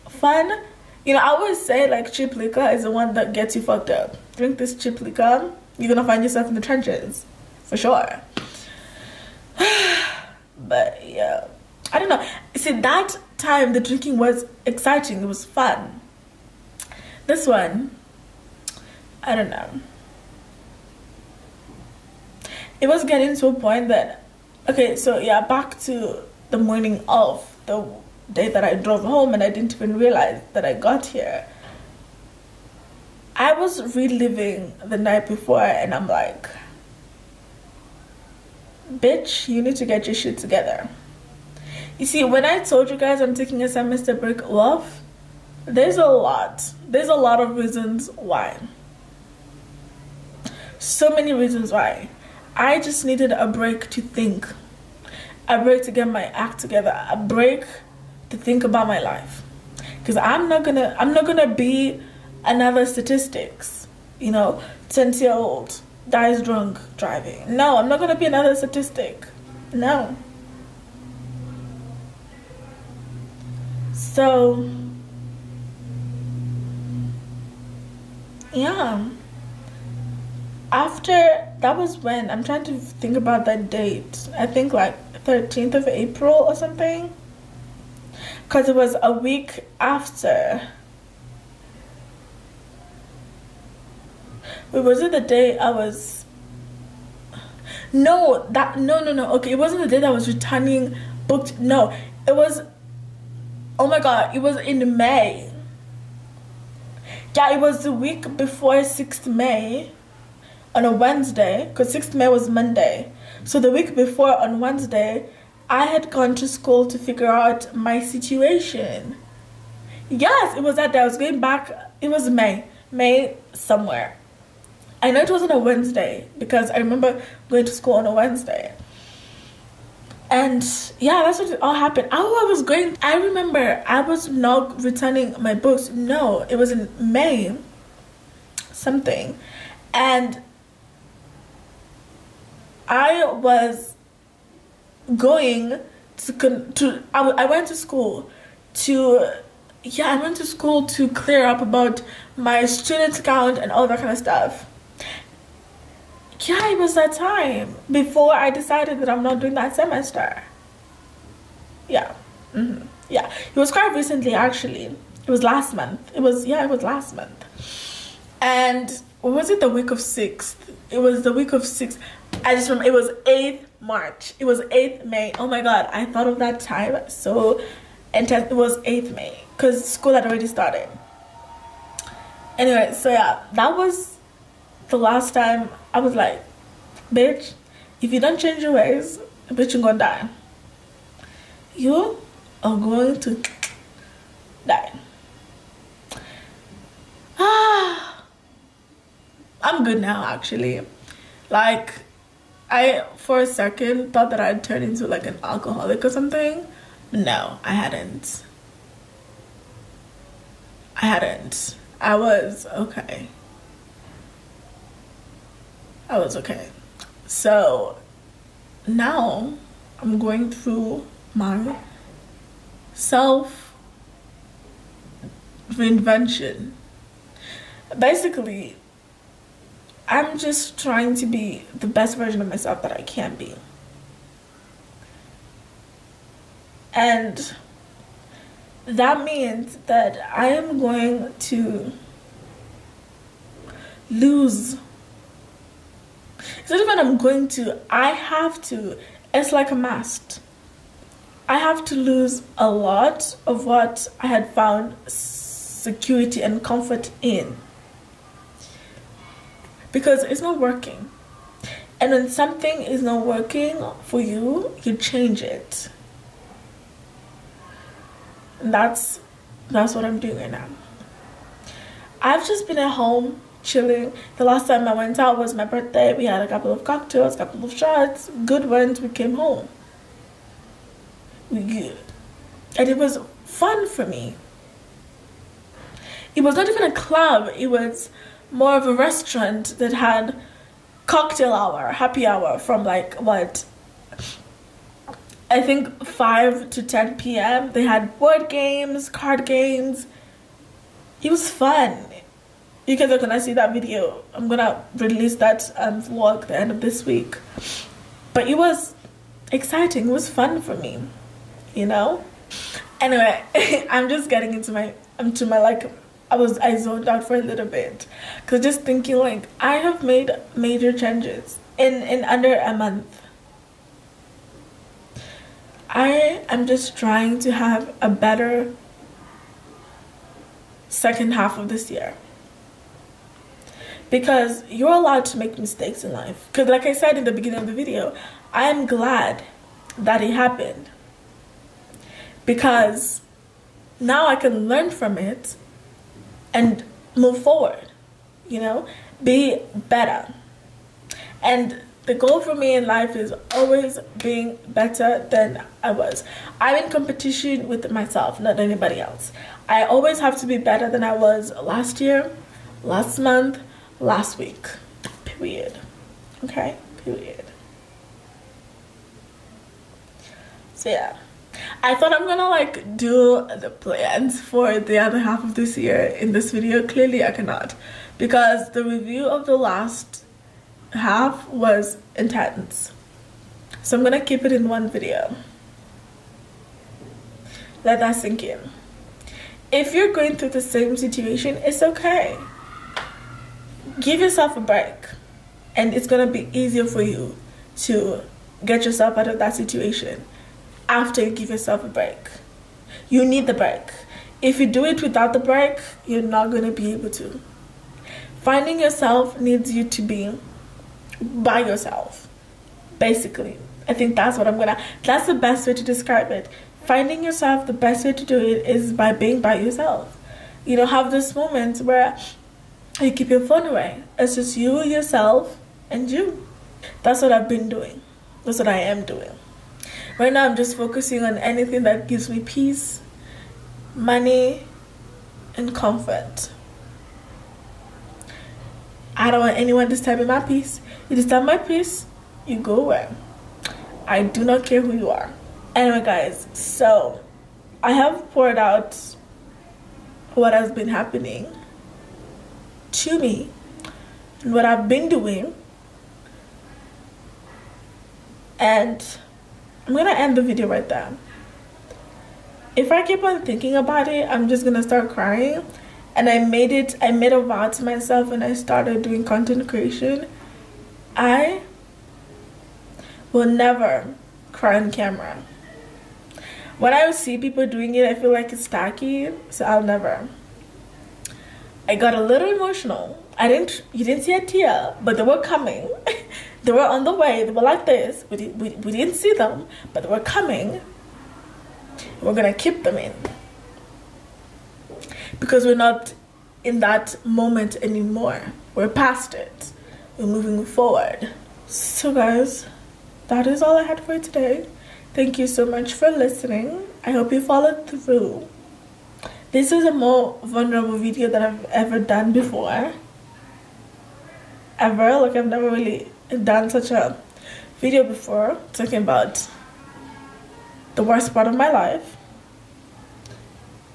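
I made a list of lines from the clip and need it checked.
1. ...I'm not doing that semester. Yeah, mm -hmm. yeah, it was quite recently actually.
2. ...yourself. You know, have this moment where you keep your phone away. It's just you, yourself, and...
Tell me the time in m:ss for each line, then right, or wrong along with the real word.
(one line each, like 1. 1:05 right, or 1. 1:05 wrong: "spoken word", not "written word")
1. 2:39 right
2. 6:59 right.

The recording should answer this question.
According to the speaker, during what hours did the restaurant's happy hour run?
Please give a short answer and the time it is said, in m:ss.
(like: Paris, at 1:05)
5 to 10 p.m., at 4:56.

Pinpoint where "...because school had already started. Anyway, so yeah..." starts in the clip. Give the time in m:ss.
2:59.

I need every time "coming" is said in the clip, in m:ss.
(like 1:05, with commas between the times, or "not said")
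8:05, 8:10.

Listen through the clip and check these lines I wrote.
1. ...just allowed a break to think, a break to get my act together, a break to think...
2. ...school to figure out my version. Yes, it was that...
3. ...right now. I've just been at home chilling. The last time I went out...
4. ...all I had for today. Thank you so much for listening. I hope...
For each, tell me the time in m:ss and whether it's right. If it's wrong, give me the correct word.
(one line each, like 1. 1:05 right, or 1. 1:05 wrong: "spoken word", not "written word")
1. 0:52 wrong: "needed", not "allowed"
2. 1:56 wrong: "situation", not "version"
3. 4:30 right
4. 8:23 right.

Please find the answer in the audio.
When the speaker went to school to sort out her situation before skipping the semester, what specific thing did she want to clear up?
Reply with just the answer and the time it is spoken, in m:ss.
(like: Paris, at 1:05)
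student account, at 2:32.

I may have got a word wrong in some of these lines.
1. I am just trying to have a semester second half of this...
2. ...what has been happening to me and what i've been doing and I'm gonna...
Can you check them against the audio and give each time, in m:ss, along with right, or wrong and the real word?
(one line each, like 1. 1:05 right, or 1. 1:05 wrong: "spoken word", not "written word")
1. 5:25 wrong: "better", not "semester"
2. 7:30 right.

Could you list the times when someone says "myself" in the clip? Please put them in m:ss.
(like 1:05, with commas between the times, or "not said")
3:52, 5:57, 7:47.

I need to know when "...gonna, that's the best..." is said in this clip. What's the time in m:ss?
6:54.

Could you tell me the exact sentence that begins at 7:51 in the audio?
I will never cry on camera.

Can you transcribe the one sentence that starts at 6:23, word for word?
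So I'm gonna keep it in one video.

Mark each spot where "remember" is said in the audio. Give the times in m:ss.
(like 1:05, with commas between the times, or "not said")
2:06, 2:13, 2:52.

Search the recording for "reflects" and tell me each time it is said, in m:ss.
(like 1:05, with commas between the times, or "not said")
not said.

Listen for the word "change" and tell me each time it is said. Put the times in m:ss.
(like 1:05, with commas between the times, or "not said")
3:08, 4:24, 5:21.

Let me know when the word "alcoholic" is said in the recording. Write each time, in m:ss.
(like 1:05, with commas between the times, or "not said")
3:25.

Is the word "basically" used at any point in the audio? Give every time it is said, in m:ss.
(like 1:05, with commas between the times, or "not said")
3:47, 6:52.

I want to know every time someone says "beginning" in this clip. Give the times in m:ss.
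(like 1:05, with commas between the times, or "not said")
5:37.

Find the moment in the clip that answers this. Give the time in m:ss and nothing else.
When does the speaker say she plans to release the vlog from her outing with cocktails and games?
5:06.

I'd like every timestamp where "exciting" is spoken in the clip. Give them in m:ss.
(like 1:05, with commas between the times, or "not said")
0:14, 5:09.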